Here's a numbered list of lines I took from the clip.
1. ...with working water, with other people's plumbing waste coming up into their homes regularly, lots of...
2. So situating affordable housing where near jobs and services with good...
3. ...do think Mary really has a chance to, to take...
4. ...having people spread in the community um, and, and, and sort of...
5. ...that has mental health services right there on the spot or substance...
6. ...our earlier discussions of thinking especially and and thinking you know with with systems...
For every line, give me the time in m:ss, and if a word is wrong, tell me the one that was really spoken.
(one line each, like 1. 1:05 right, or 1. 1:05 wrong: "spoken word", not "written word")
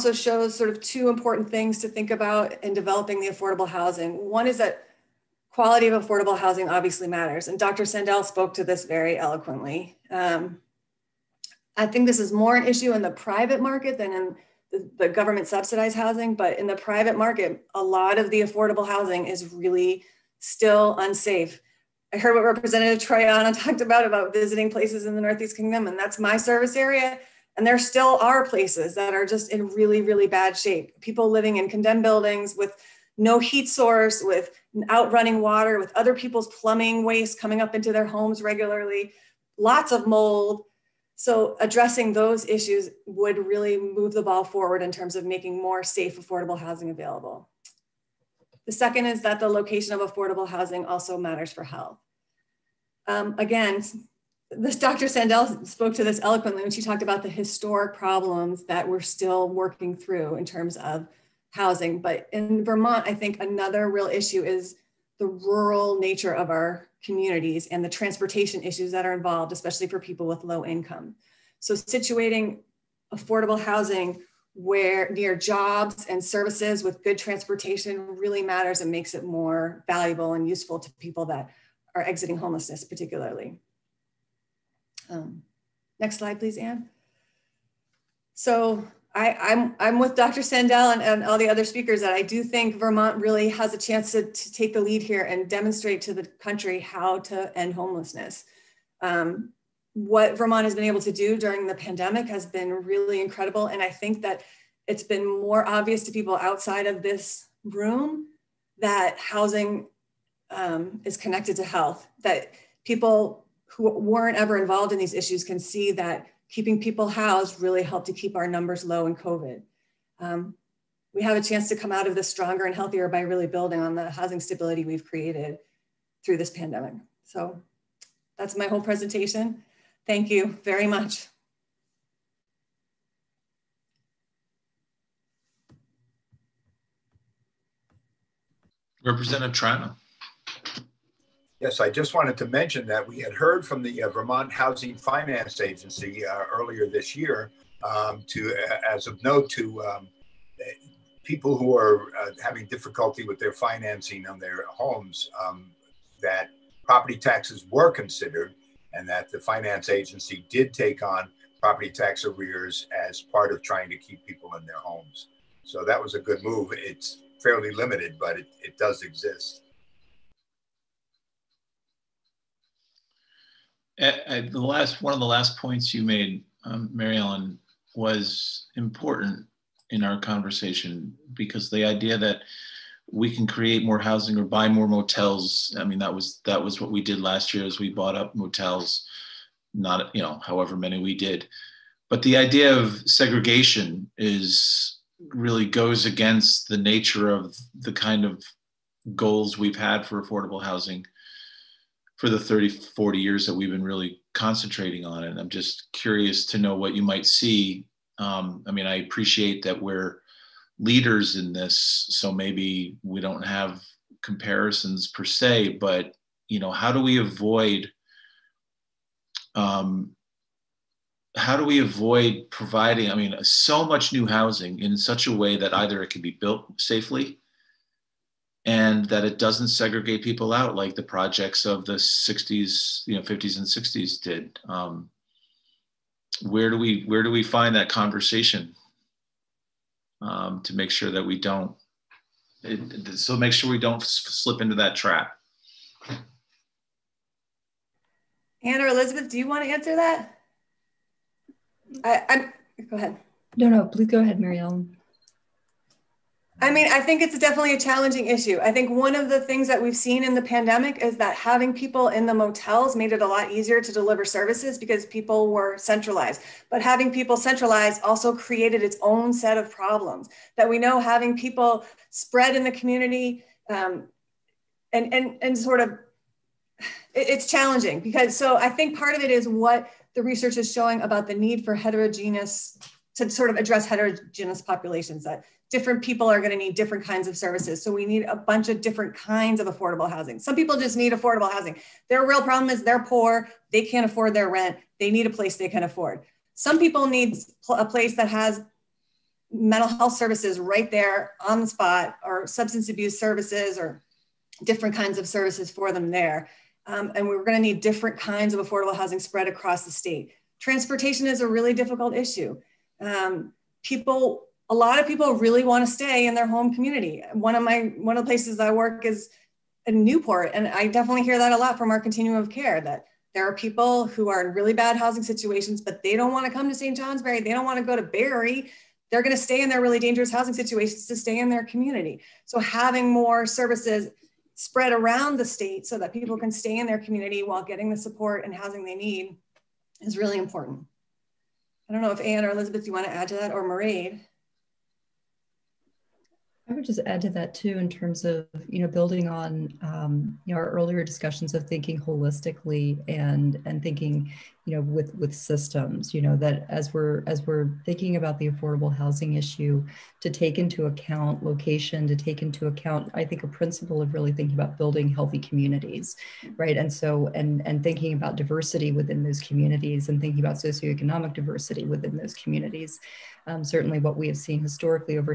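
1. 0:34 wrong: "outrunning", not "working"
2. 1:11 right
3. 1:32 wrong: "Vermont", not "Mary"
4. 4:31 right
5. 4:58 right
6. 5:50 wrong: "holistically", not "especially".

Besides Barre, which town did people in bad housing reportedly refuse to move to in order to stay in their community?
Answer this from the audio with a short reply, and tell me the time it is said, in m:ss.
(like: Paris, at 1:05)
St. Johnsbury, at 5:26.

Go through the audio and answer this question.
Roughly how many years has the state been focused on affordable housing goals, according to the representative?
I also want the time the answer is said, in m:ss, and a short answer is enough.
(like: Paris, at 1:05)
30, 40 years, at 3:22.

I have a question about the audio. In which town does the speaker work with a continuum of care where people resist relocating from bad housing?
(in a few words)
Newport.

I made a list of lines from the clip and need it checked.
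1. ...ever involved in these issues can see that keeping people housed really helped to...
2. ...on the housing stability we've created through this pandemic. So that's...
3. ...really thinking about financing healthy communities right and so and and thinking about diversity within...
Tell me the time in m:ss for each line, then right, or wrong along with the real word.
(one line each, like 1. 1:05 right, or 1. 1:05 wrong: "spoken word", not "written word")
1. 1:54 right
2. 2:03 right
3. 6:04 wrong: "building", not "financing".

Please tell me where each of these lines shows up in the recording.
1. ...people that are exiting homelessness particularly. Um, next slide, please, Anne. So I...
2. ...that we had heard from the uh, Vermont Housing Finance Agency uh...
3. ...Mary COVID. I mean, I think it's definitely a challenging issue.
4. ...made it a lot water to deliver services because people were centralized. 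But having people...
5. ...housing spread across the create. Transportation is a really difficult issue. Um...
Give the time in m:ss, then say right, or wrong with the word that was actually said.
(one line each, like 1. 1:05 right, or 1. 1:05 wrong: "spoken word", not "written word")
1. 1:20 right
2. 2:22 right
3. 4:14 wrong: "Ellen", not "COVID"
4. 4:22 wrong: "easier", not "water"
5. 5:08 wrong: "state", not "create".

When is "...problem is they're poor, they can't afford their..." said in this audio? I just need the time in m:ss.
4:52.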